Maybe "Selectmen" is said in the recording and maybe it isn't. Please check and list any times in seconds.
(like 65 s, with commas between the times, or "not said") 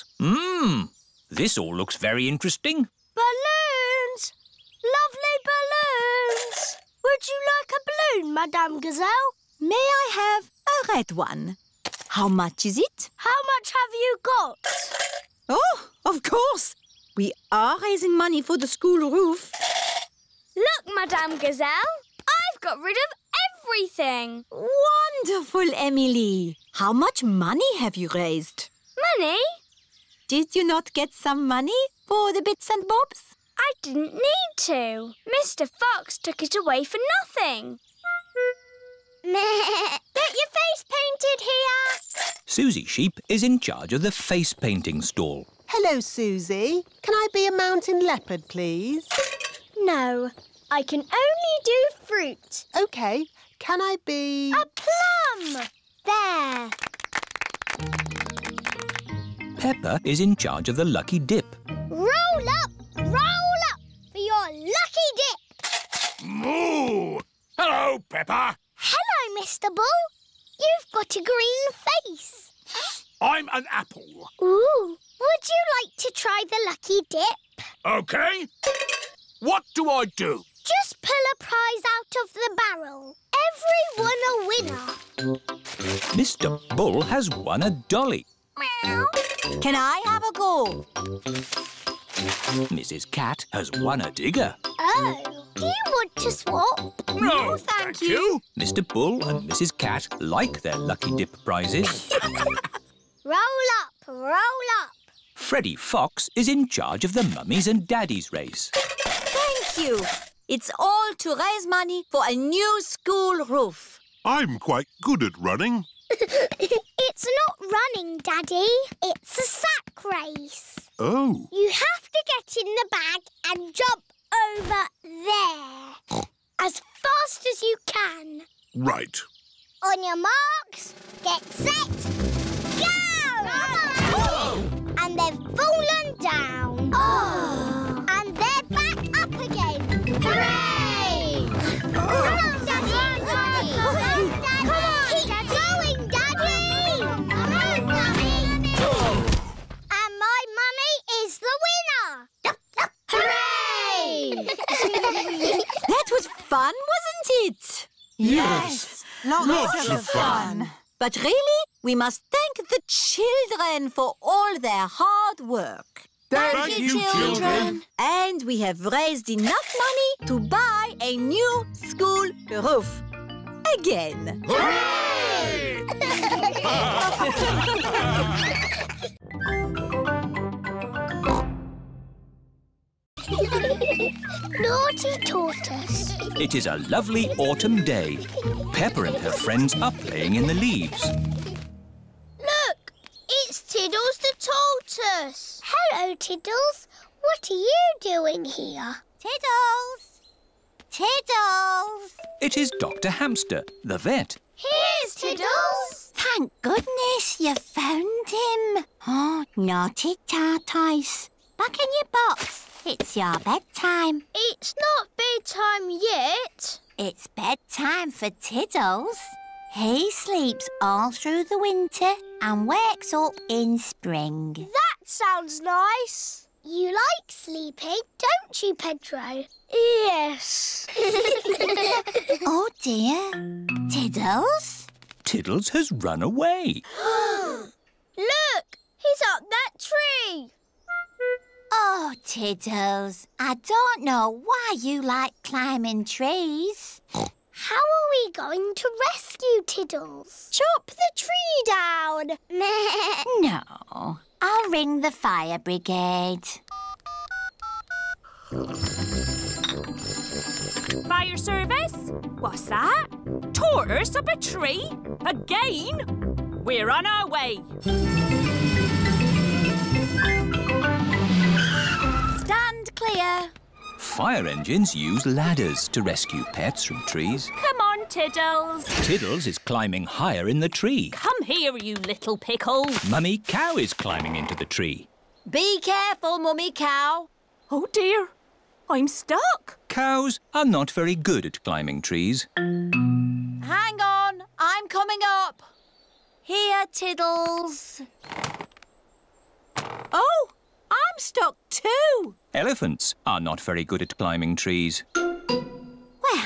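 not said.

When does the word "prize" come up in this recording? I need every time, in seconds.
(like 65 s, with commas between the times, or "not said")
81 s, 101 s.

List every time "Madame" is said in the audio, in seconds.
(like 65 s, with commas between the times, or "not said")
8 s, 20 s.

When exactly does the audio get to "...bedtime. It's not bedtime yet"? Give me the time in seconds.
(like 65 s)
213 s.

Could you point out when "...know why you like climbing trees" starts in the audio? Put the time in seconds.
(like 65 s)
244 s.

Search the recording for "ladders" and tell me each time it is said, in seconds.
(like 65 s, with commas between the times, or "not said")
275 s.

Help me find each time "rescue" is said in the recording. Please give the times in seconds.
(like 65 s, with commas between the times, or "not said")
249 s, 276 s.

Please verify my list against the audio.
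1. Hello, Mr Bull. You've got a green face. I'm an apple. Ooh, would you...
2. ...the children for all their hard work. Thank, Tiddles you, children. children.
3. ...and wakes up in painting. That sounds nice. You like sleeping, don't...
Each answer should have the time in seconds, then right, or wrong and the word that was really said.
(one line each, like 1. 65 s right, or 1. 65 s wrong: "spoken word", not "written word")
1. 68 s right
2. 162 s wrong: "Thank", not "Tiddles"
3. 222 s wrong: "spring", not "painting".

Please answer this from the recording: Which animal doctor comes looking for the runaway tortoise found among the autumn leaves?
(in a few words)
Dr Hamster.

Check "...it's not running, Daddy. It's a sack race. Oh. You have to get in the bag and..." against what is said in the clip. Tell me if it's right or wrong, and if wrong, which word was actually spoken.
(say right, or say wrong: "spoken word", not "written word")
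right.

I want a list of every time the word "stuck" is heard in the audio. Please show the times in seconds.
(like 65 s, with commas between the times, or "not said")
289 s, 301 s.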